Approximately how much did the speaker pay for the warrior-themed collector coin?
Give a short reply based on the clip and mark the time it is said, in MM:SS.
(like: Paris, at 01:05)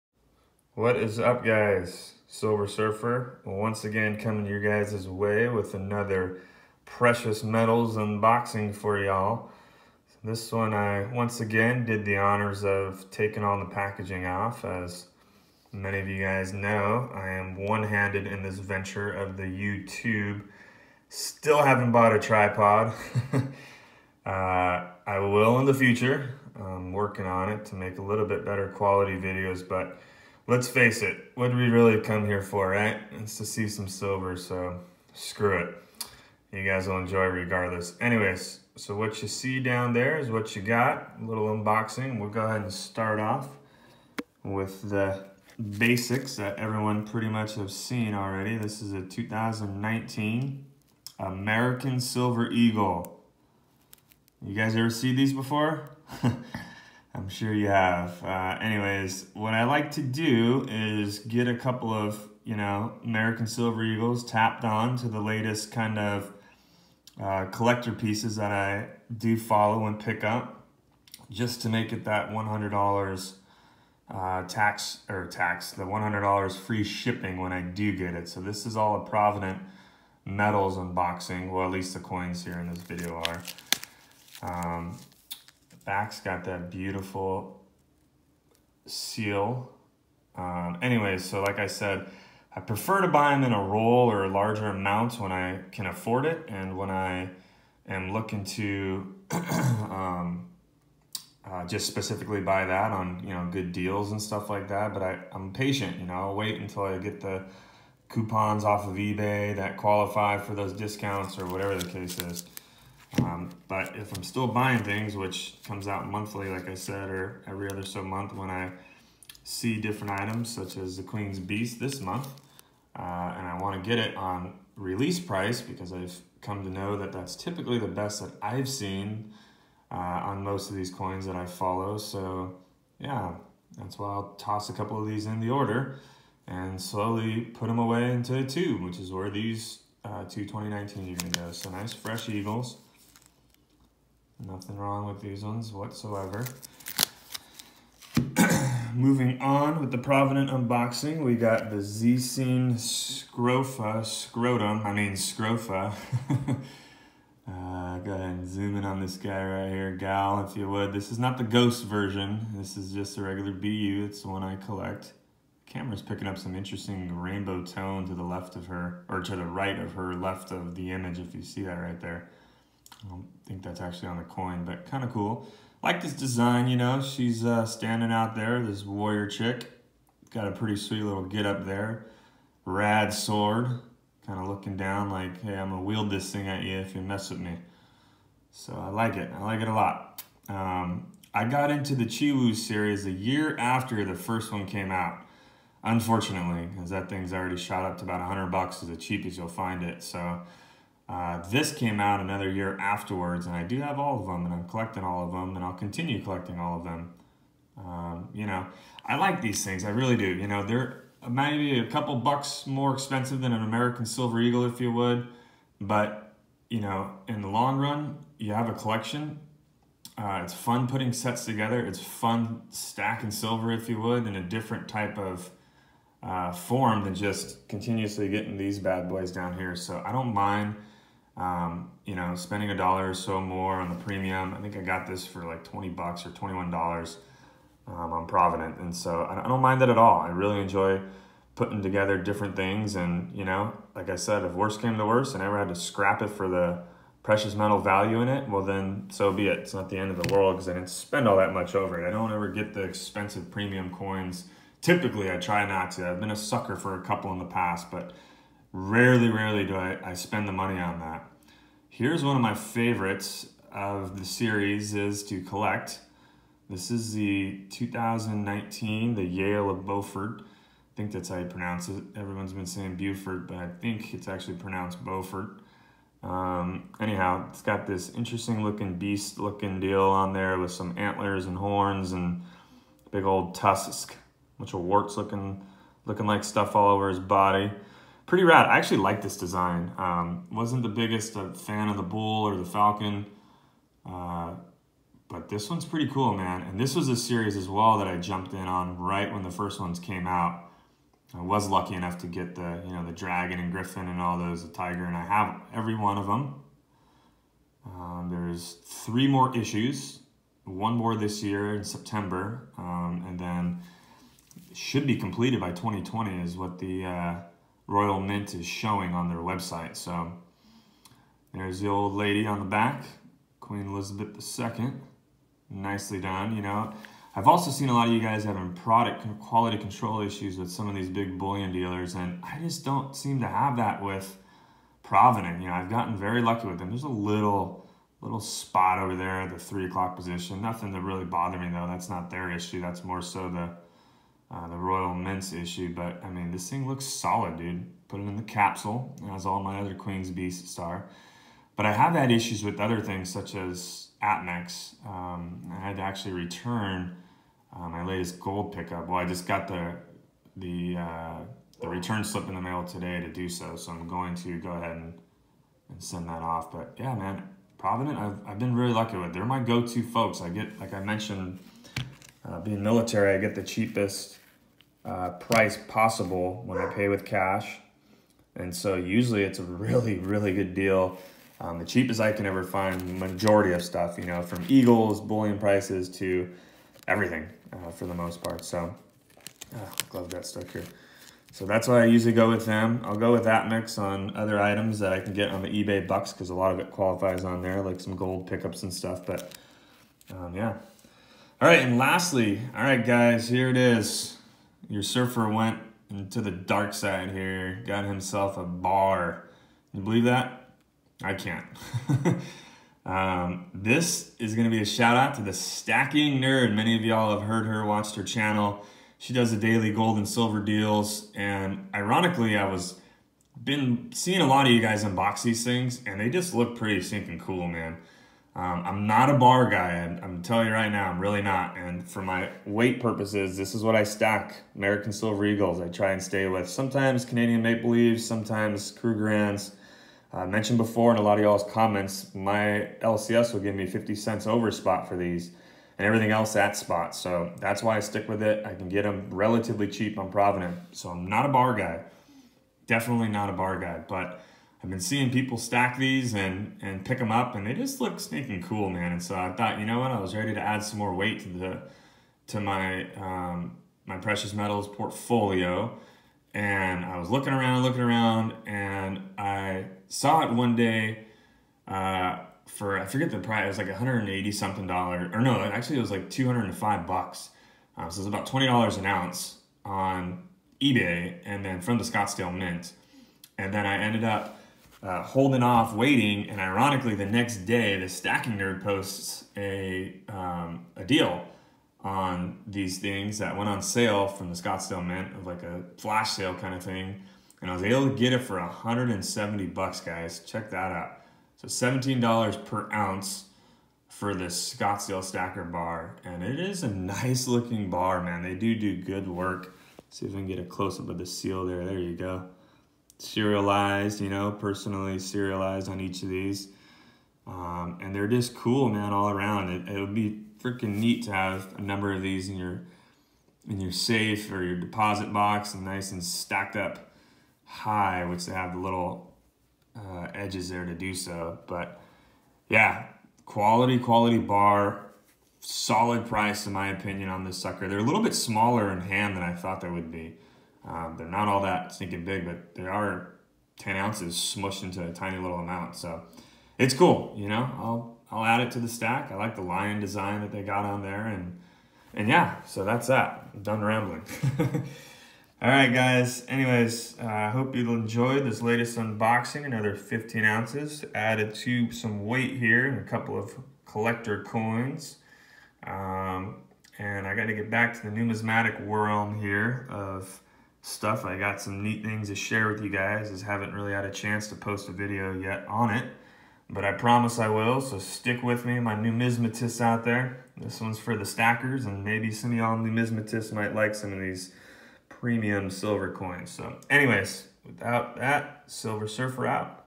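$21, at 03:56.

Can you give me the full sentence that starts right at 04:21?
Here's one of my favorites of the series is to collect.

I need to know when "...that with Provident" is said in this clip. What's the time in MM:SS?
05:33.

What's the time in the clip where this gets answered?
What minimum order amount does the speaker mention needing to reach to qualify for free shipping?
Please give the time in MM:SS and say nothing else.
01:15.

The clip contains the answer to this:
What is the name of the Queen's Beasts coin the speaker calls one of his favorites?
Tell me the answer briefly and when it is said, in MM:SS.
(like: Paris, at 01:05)
Yale of Beaufort, at 04:29.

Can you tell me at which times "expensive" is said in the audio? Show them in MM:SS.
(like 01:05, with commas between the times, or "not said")
03:32, 04:12.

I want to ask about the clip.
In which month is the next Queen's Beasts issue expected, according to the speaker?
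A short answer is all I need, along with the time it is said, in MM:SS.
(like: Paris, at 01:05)
September, at 05:11.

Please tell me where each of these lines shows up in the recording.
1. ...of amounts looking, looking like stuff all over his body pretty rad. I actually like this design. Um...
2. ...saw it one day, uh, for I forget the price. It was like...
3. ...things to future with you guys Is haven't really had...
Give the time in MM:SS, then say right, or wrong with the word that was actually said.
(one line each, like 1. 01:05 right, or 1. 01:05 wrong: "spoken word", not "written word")
1. 04:44 wrong: "warts", not "amounts"
2. 07:50 right
3. 09:32 wrong: "share", not "future".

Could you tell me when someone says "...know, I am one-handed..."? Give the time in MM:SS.
00:16.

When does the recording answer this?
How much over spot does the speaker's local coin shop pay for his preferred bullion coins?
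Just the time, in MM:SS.
07:23.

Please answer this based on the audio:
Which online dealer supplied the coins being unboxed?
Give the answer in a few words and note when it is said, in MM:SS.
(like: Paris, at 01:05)
Provident Metals, at 01:19.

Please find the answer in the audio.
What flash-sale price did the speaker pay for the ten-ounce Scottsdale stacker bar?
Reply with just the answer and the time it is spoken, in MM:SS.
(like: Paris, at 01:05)
$170, at 08:18.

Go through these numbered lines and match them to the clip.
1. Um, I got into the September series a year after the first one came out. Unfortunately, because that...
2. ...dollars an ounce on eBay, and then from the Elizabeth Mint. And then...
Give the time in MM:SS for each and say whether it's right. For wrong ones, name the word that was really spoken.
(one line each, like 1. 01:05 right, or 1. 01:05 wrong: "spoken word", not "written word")
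1. 03:10 wrong: "Chiwu", not "September"
2. 07:58 wrong: "Scottsdale", not "Elizabeth".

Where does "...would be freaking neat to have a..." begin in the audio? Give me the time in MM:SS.
08:39.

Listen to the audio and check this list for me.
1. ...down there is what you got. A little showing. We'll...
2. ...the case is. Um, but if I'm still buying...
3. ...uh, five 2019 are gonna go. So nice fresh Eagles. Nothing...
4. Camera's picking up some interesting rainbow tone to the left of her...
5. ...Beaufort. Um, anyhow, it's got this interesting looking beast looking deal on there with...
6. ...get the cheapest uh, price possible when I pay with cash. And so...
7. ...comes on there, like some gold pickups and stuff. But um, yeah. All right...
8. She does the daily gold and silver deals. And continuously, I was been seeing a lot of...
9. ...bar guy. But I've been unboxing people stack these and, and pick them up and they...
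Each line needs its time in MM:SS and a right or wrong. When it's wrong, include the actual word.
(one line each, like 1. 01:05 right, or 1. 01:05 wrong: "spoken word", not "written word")
1. 00:39 wrong: "unboxing", not "showing"
2. 01:51 right
3. 02:20 wrong: "two", not "five"
4. 02:45 right
5. 04:35 right
6. 06:13 right
7. 06:36 wrong: "qualifies", not "comes"
8. 06:59 wrong: "ironically", not "continuously"
9. 07:33 wrong: "seeing", not "unboxing".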